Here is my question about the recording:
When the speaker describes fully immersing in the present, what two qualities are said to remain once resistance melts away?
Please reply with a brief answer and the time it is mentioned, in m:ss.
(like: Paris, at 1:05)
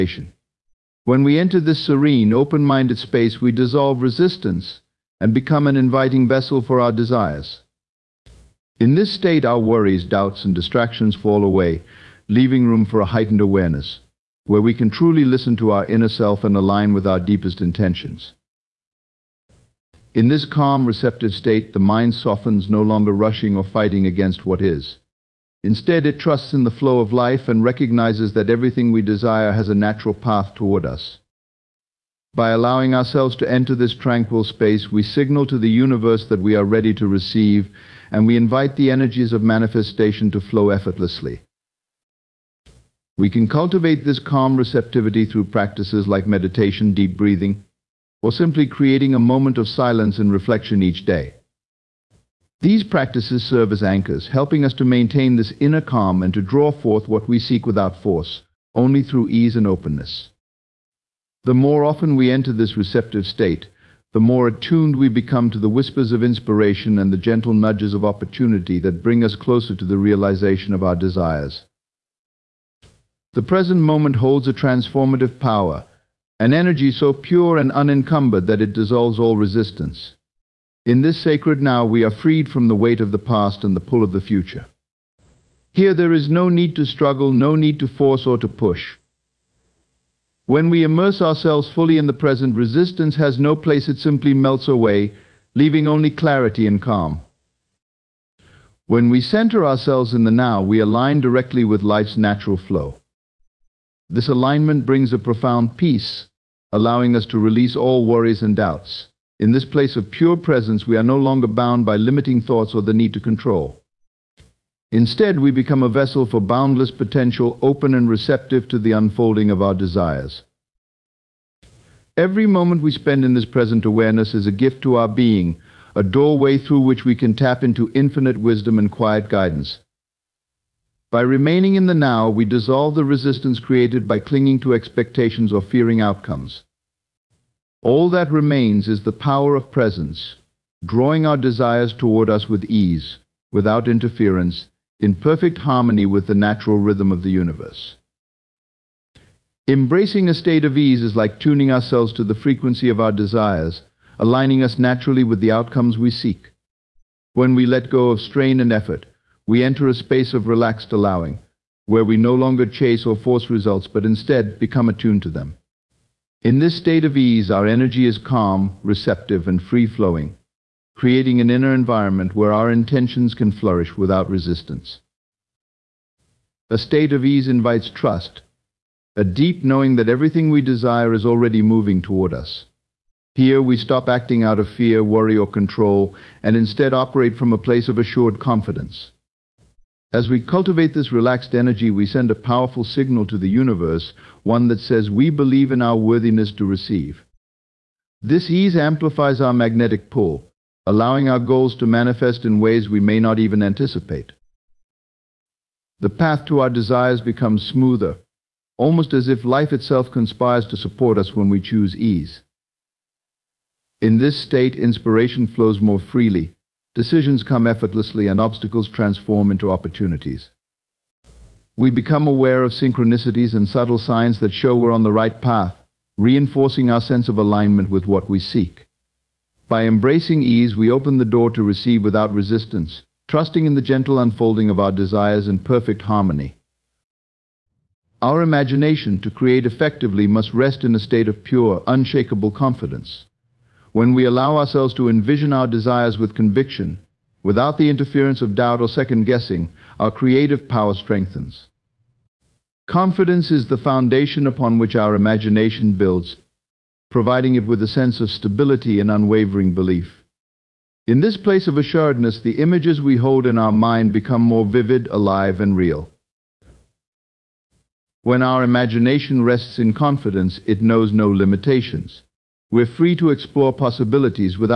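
clarity and calm, at 1:36.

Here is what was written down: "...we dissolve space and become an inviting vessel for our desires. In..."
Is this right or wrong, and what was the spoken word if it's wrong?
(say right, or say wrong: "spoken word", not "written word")
wrong: "resistance", not "space".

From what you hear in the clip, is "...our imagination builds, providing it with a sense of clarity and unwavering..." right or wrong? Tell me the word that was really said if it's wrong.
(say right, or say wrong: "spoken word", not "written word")
wrong: "stability", not "clarity".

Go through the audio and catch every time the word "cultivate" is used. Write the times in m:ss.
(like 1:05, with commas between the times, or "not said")
0:43, 3:10.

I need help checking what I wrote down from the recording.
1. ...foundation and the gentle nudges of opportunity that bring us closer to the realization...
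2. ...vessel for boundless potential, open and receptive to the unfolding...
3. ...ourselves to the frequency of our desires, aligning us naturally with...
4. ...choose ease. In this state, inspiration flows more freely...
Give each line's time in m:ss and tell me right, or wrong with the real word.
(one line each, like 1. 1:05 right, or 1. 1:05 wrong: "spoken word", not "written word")
1. 1:06 wrong: "inspiration", not "foundation"
2. 1:55 right
3. 2:31 right
4. 3:31 right.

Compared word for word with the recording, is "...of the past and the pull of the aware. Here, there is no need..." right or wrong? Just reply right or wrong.
wrong.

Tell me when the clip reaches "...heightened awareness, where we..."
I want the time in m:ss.
0:13.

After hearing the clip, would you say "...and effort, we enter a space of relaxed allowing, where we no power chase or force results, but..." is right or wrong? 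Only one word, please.
wrong.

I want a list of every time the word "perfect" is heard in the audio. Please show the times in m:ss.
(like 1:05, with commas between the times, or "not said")
2:25, 3:55.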